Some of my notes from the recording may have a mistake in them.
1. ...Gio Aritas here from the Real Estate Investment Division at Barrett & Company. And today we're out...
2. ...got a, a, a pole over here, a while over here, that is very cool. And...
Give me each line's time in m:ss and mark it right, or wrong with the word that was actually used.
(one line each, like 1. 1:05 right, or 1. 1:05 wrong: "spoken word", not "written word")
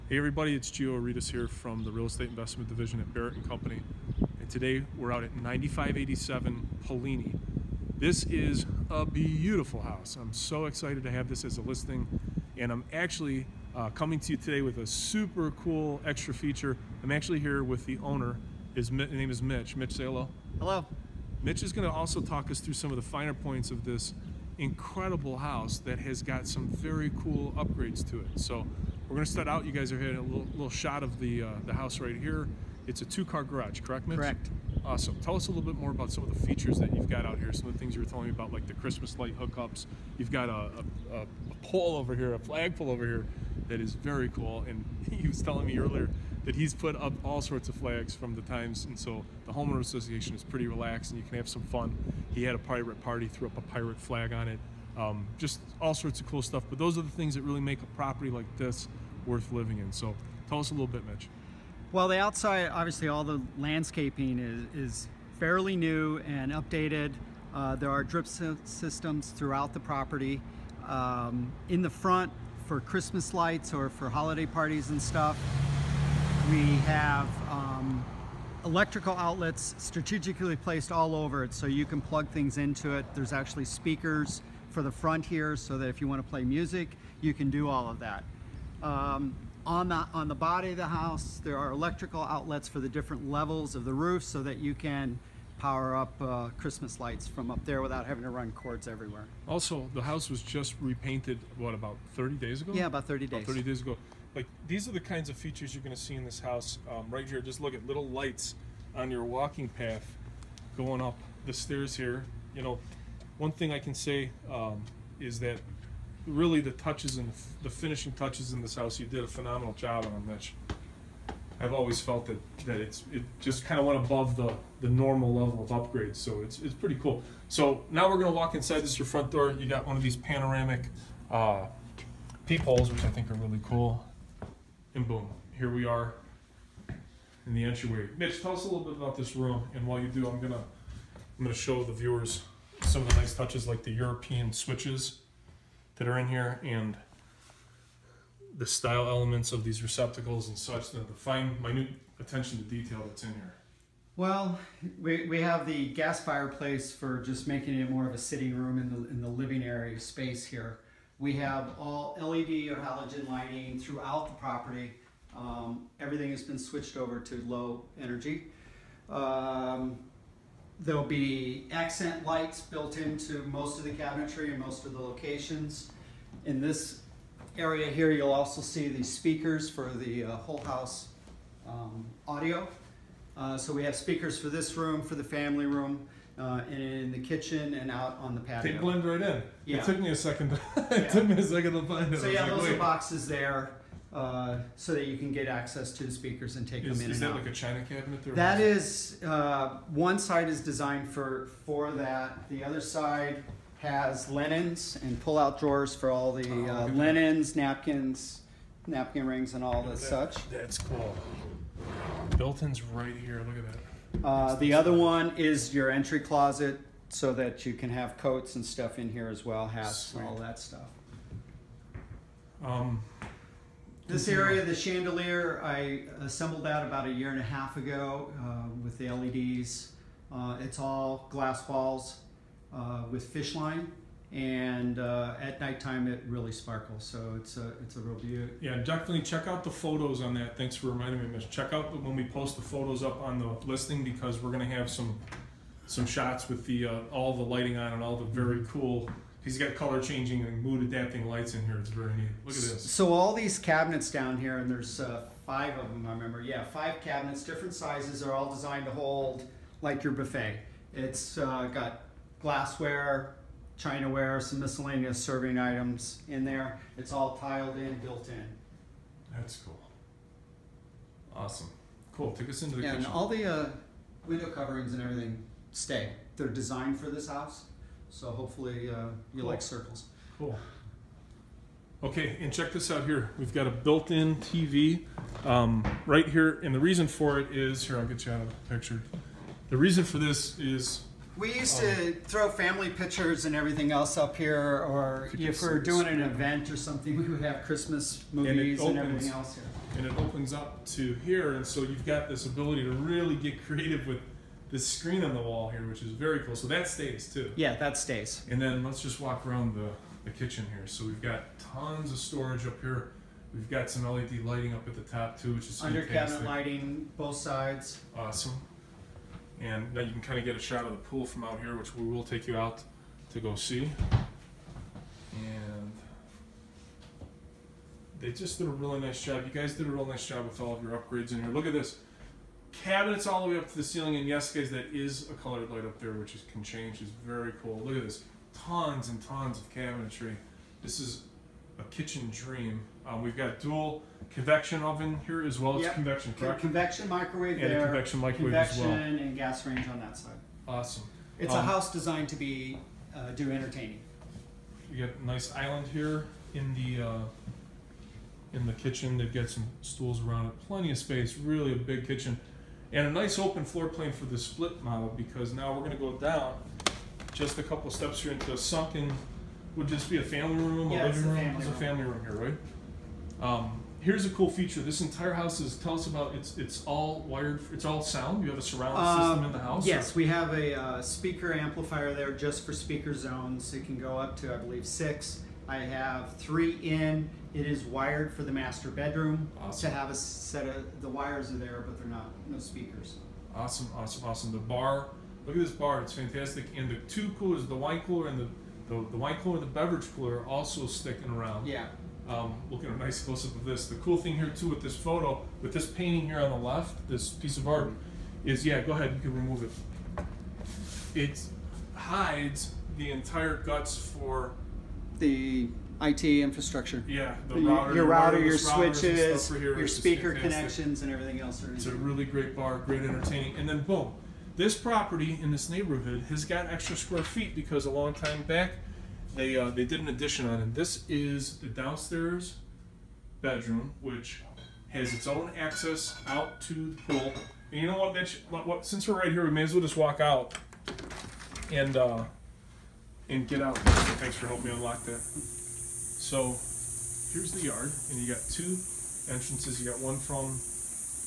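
1. 0:00 right
2. 0:40 wrong: "flagpole", not "while".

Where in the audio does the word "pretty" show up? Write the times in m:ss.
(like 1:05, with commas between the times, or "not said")
0:50, 2:06.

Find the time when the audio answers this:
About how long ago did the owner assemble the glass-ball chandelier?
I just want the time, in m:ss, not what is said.
3:47.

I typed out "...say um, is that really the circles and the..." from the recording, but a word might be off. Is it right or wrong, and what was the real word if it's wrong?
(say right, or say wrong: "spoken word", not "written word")
wrong: "touches", not "circles".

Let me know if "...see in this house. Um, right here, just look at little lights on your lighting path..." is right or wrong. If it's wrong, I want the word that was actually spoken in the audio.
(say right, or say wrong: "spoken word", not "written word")
wrong: "walking", not "lighting".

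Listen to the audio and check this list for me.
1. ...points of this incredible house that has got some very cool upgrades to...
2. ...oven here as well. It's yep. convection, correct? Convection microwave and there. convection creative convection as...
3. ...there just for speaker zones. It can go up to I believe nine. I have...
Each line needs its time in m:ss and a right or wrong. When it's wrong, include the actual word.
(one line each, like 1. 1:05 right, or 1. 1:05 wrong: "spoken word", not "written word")
1. 0:23 right
2. 5:44 wrong: "microwave", not "creative"
3. 6:22 wrong: "six", not "nine".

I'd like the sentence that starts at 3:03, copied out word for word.
Uh, so we have speakers for this room, for the family room, uh, and in the kitchen and out on the patio.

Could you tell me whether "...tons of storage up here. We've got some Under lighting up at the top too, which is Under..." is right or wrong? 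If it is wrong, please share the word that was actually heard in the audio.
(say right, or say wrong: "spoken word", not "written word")
wrong: "LED", not "Under".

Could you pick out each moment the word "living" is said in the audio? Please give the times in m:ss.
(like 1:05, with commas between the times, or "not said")
0:59, 2:39, 6:11.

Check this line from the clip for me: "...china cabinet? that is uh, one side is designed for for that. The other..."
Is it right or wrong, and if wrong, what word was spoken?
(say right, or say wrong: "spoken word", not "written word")
right.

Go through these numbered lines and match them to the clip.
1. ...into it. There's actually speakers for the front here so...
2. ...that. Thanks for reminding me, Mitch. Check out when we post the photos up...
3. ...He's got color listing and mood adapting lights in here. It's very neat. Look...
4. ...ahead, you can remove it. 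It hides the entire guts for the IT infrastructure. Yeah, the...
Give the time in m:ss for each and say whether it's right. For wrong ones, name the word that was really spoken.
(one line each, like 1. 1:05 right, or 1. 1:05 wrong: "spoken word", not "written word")
1. 1:22 right
2. 4:00 right
3. 4:09 wrong: "changing", not "listing"
4. 6:48 right.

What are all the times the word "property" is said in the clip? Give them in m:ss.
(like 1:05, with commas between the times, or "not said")
0:57, 1:09, 2:44, 7:04.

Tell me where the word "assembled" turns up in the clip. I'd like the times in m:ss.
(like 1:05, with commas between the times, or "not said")
3:46.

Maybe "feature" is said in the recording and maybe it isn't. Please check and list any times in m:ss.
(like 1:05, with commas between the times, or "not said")
0:16, 0:36, 1:45, 6:14.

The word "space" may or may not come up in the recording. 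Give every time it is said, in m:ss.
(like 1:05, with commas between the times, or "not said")
2:39, 6:00.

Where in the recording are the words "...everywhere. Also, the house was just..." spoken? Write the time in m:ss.
1:38.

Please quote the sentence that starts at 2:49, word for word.
Um, There'll be accent lights built into most of the cabinetry and most of the locations.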